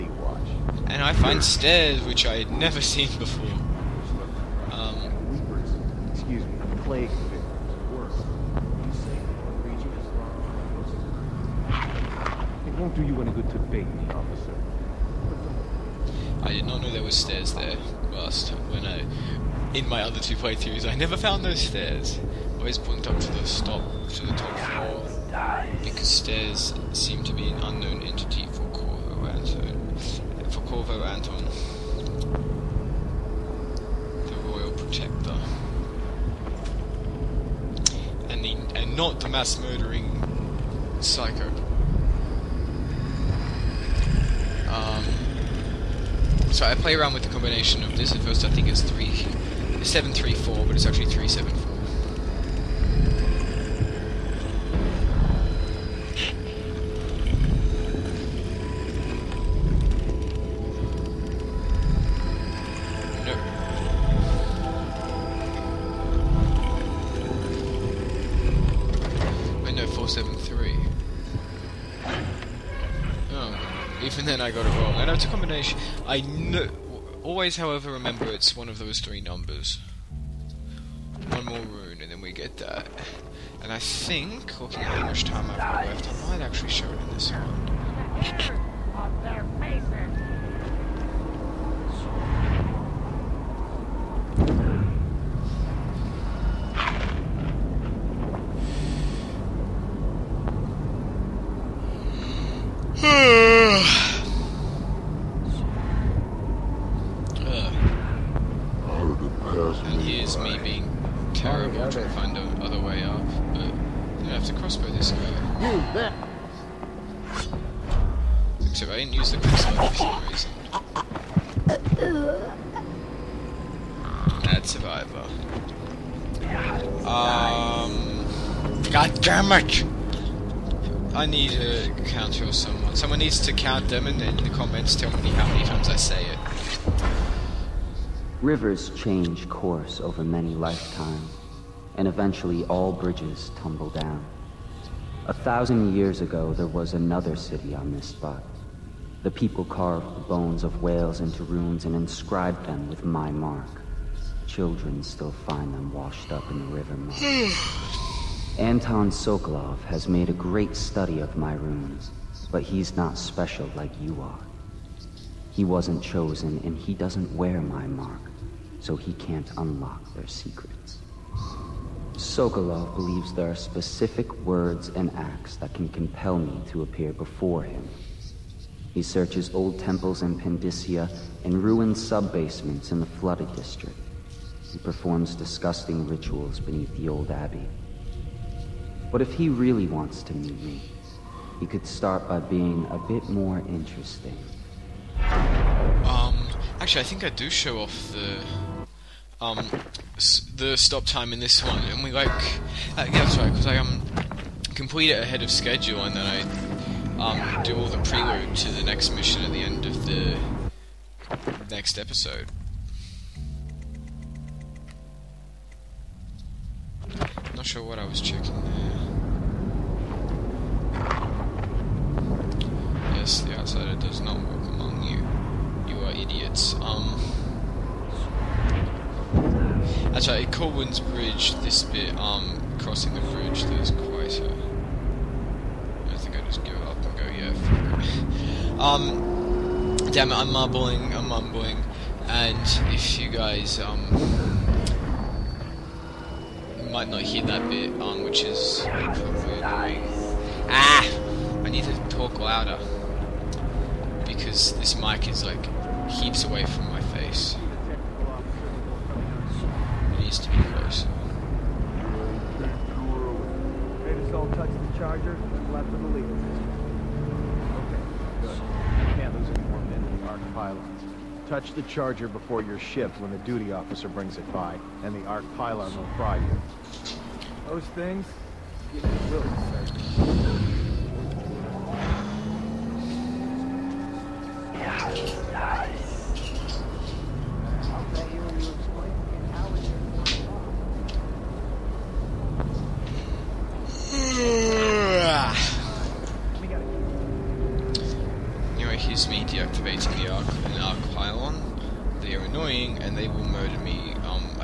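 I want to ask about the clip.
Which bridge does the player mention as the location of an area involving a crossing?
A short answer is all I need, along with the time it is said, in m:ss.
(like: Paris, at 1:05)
Corwin's Bridge, at 3:50.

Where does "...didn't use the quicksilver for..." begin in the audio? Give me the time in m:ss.
1:58.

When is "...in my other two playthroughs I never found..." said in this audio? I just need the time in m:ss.
0:19.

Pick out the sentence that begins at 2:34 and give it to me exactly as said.
Children still find them washed up in the river mud.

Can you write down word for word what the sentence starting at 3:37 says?
Not sure what I was checking there.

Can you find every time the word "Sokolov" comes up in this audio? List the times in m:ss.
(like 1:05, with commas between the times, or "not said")
2:39, 2:52.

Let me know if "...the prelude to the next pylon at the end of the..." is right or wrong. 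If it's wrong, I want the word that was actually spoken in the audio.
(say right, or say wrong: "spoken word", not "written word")
wrong: "mission", not "pylon".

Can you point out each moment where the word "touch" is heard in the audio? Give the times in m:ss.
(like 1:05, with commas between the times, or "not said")
4:24, 4:31.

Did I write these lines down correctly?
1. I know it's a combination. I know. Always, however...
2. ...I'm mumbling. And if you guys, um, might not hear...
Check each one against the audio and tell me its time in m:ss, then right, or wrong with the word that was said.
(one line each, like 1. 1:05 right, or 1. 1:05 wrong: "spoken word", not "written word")
1. 1:14 right
2. 4:01 right.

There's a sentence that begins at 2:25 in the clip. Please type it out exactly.
A thousand years ago, there was another city on this spot.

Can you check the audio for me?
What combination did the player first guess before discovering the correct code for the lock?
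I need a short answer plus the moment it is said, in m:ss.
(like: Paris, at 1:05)
3734, at 0:48.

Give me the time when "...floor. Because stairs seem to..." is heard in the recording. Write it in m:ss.
0:24.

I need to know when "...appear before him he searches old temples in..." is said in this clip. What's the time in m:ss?
2:56.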